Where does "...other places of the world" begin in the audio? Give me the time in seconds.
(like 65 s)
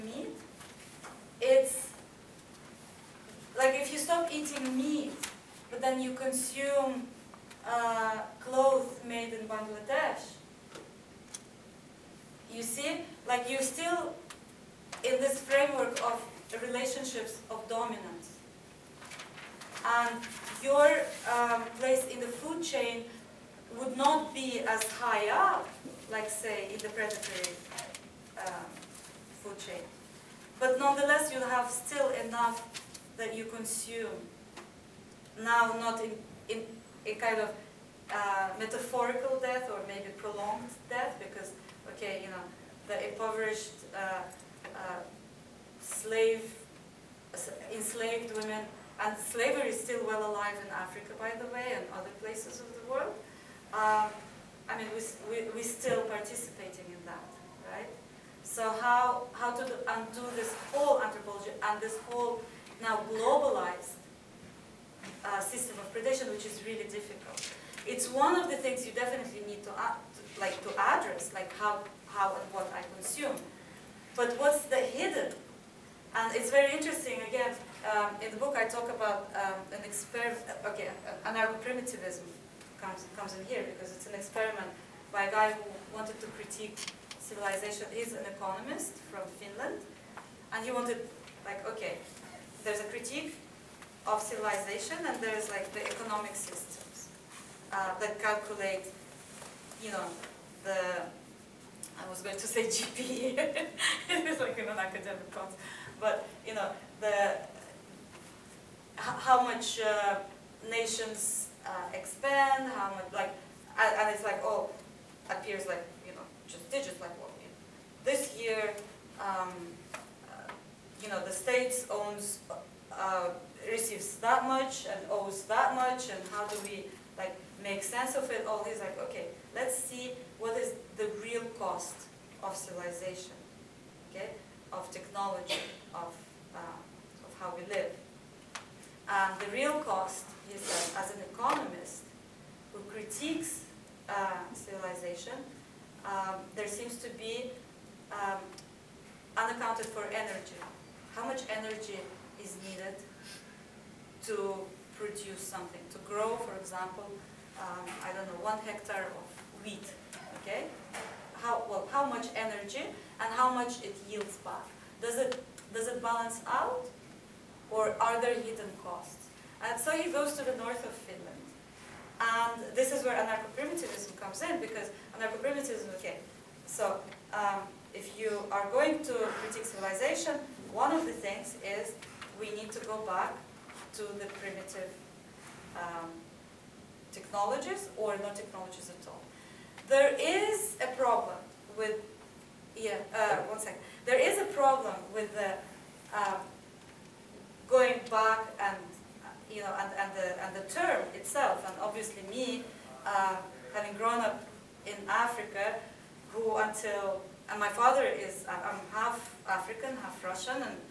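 51 s.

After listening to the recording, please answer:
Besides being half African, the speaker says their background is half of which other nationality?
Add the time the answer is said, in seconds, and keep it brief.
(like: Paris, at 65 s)
Russian, at 210 s.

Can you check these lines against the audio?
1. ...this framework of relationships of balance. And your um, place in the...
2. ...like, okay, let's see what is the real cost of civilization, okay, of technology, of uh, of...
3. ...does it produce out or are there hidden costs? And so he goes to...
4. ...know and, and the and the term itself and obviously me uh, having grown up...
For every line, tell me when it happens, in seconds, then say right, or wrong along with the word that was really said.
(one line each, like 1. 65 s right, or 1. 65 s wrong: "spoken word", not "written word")
1. 15 s wrong: "dominance", not "balance"
2. 128 s right
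3. 165 s wrong: "balance", not "produce"
4. 199 s right.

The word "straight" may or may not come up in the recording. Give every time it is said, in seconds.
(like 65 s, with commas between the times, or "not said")
not said.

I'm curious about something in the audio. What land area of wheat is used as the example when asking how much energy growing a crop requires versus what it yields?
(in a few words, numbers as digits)
1 hectare.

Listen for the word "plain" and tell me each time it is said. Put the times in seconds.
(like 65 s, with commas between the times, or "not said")
not said.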